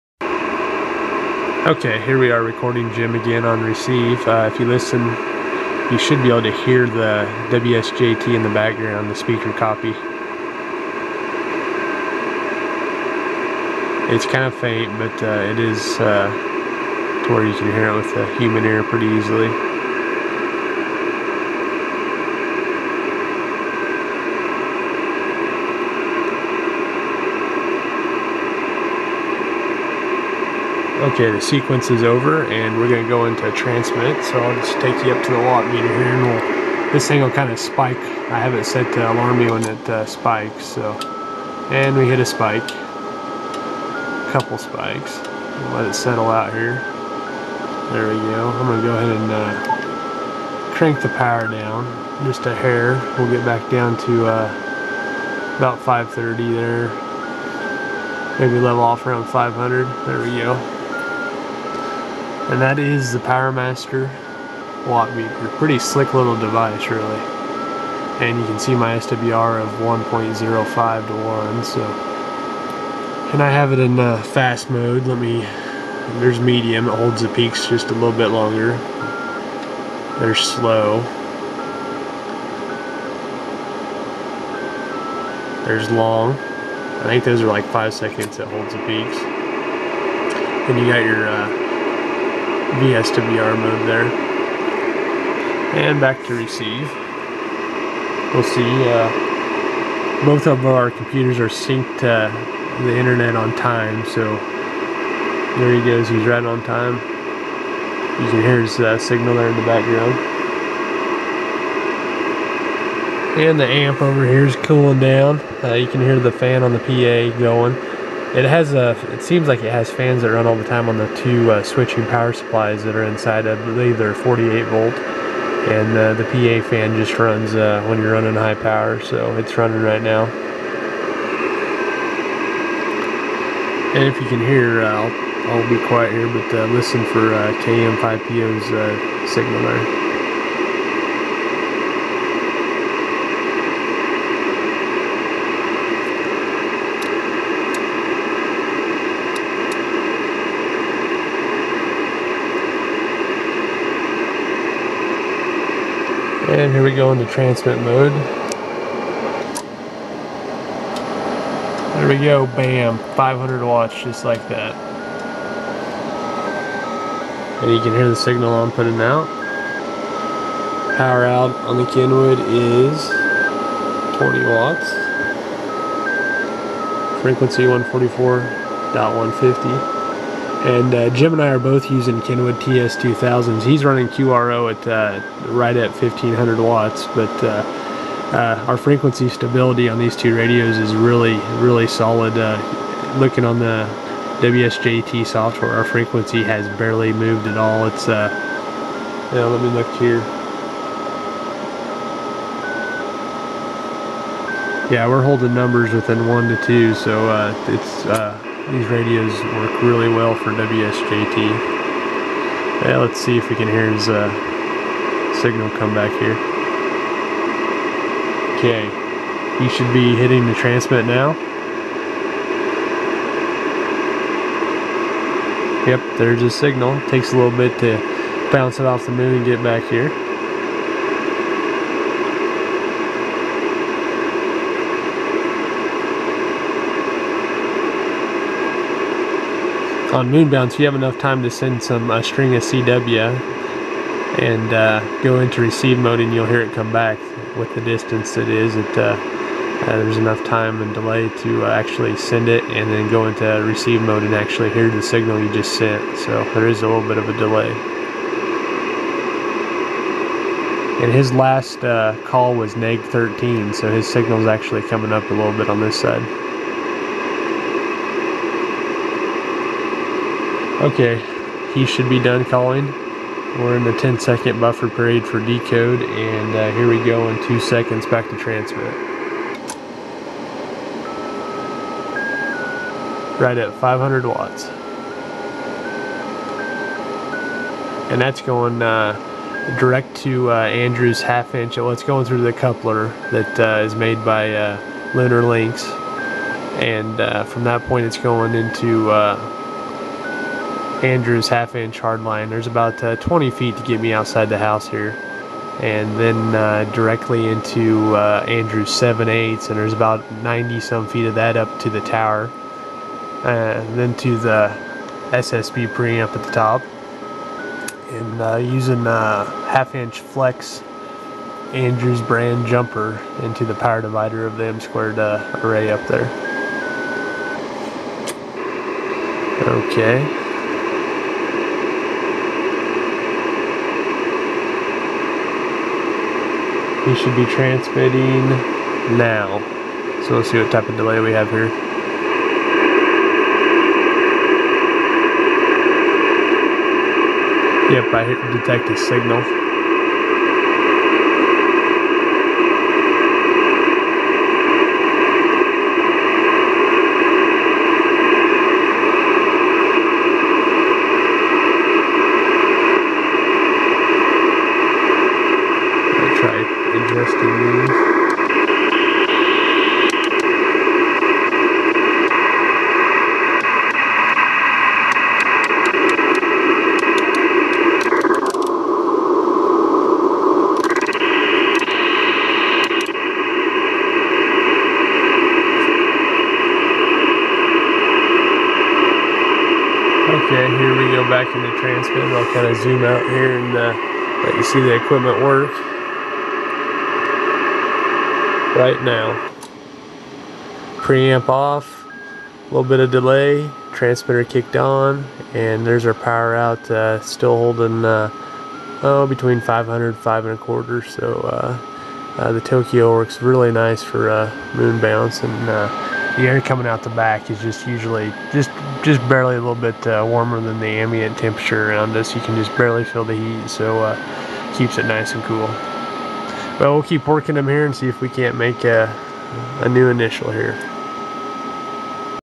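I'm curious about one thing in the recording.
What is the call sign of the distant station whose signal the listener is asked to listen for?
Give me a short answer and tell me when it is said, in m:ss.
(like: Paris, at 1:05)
KM5PO, at 2:17.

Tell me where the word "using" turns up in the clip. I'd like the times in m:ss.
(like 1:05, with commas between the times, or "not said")
3:01, 5:18.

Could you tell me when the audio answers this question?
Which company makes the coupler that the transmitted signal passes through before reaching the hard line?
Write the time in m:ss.
4:55.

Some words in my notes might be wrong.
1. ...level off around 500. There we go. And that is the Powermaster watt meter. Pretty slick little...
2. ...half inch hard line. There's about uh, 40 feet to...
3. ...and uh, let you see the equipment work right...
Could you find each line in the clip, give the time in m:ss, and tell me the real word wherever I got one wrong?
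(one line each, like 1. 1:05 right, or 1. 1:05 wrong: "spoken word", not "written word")
1. 0:58 right
2. 5:01 wrong: "20", not "40"
3. 6:33 right.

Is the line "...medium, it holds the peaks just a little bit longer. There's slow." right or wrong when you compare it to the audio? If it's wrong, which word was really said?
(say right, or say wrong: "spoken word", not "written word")
right.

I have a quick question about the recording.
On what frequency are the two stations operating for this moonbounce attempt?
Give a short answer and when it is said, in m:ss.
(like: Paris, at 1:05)
144.150, at 2:57.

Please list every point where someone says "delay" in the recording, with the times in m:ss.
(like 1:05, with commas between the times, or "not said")
4:10, 4:17, 5:40, 6:43.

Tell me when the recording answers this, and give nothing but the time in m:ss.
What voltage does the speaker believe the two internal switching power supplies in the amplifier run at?
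2:04.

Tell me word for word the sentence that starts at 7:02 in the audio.
You can just barely feel the heat, so keeps it nice and cool.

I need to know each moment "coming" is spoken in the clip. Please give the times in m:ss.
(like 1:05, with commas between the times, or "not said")
4:24, 6:56.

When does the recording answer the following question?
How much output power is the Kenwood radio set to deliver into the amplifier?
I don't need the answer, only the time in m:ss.
2:54.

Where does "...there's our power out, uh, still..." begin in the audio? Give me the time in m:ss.
6:45.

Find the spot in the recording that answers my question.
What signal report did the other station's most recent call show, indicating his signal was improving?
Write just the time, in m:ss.
4:22.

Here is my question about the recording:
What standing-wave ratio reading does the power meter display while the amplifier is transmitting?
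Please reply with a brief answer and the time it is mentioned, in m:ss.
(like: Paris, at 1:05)
1.05 to 1, at 1:09.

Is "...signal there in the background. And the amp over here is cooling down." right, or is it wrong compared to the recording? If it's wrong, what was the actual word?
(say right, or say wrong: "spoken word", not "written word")
right.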